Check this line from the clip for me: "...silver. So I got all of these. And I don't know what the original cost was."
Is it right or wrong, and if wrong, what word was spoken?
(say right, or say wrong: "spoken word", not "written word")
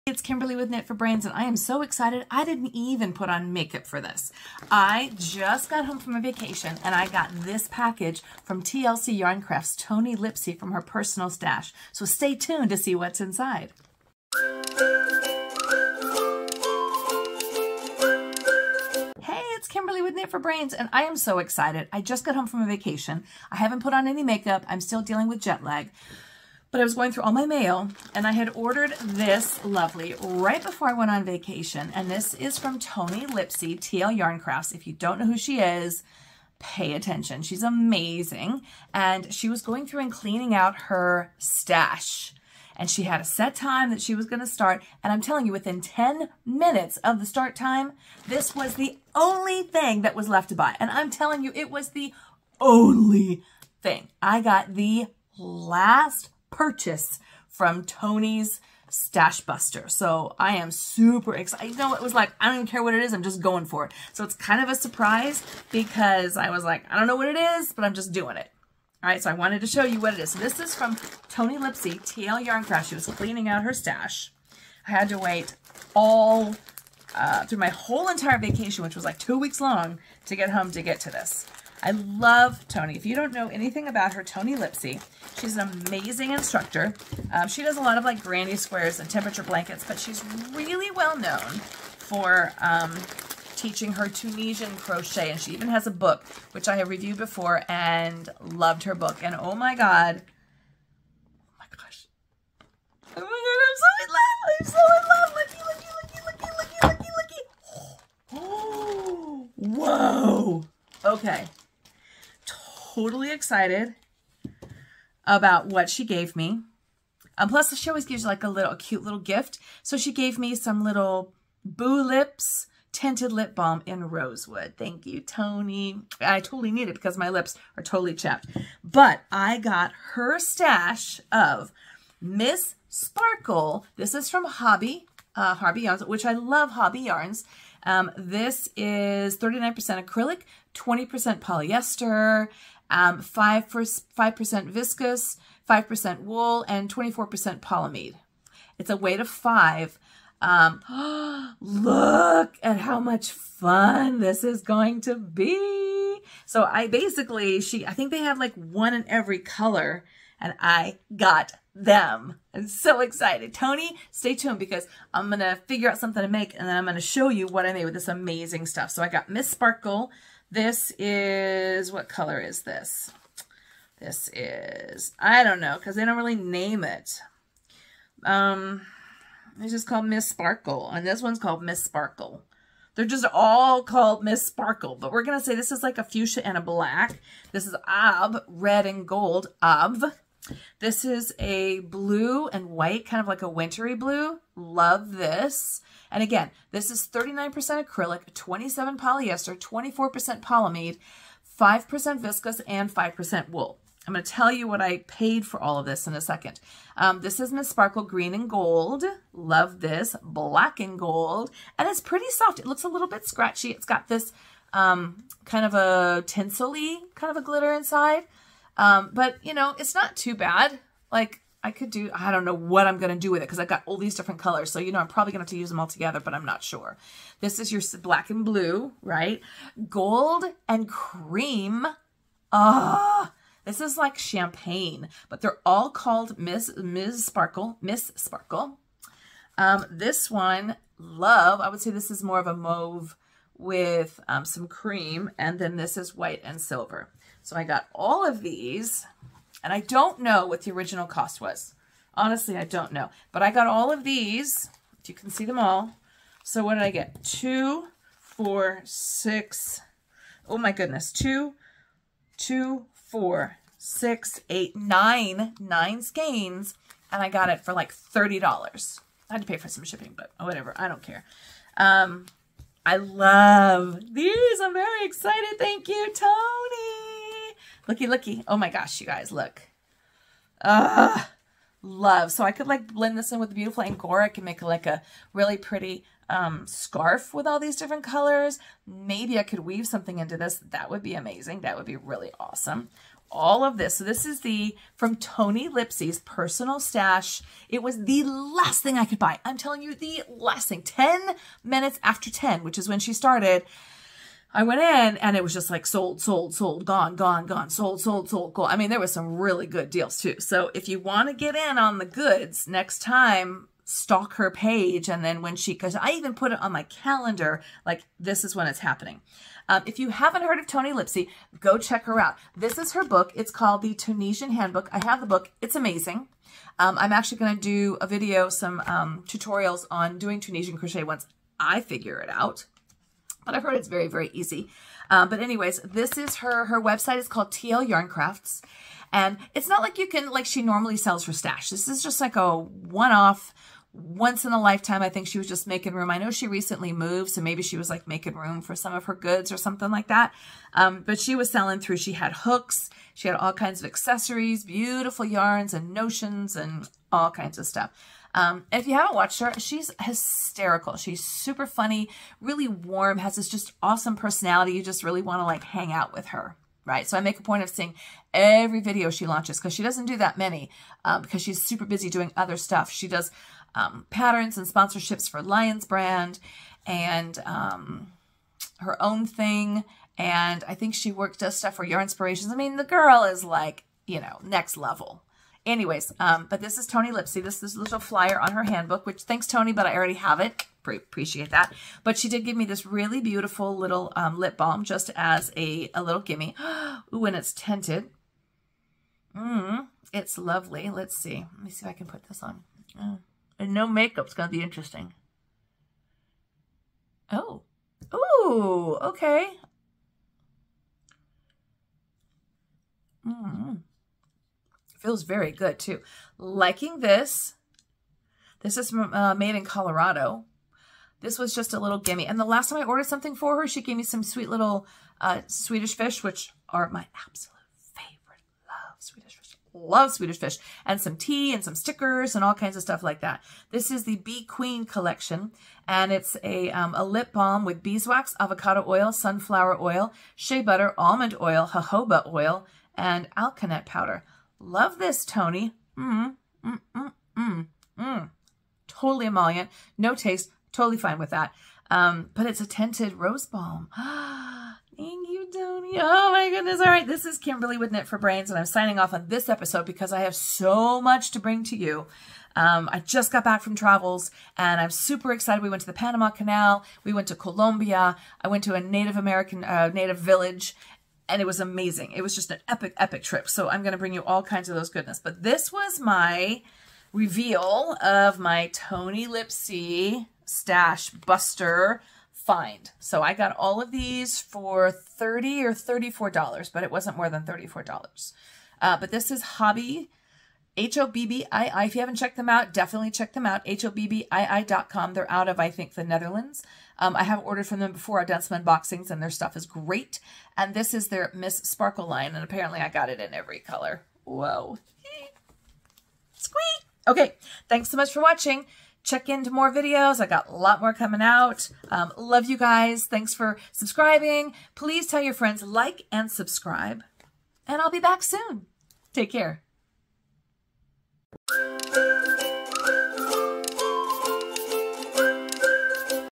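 right.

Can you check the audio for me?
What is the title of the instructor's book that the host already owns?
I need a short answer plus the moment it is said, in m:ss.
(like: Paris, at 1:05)
The Tunisian Handbook, at 5:23.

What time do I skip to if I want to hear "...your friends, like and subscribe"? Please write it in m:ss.
8:35.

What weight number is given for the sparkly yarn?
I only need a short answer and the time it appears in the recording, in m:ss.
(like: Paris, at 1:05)
5, at 2:28.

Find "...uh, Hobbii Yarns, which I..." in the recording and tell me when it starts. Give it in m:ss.
2:15.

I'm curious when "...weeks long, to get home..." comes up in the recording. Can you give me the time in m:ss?
1:19.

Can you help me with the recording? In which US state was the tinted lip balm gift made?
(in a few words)
Colorado.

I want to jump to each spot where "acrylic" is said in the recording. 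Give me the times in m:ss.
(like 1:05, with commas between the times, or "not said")
2:20, 3:17.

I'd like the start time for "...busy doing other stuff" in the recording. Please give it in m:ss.
6:11.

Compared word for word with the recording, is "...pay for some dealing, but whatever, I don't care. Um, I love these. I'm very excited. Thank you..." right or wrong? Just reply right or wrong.
wrong.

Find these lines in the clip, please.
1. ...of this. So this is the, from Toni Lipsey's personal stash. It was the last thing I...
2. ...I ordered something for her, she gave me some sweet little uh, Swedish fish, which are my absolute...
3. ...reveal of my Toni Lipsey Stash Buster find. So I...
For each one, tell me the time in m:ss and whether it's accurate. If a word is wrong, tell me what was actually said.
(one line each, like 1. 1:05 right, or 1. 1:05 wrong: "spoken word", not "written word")
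1. 4:53 right
2. 7:02 right
3. 7:57 right.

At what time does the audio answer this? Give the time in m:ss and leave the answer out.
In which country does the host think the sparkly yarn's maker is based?
8:15.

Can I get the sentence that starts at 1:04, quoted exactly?
So it's kind of a surprise because I was like, I don't know what it is, but I'm just doing it.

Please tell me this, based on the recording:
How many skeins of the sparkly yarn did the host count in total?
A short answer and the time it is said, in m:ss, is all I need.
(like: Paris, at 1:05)
9, at 4:25.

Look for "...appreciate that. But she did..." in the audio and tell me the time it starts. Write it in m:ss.
6:30.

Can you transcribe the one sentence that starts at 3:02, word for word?
They're just all called Miss Sparkle, but we're going to say this is like a fuchsia and a black.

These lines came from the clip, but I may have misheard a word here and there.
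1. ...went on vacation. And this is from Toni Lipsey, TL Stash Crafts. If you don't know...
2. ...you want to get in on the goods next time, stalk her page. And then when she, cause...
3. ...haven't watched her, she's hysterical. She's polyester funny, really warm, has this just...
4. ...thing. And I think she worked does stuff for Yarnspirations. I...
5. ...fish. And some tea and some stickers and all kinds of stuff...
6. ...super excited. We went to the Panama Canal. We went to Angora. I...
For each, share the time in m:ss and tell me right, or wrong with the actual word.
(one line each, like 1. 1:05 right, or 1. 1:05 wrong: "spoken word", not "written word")
1. 0:30 wrong: "Yarn", not "Stash"
2. 5:10 right
3. 5:58 wrong: "super", not "polyester"
4. 6:19 right
5. 7:10 right
6. 7:44 wrong: "Colombia", not "Angora".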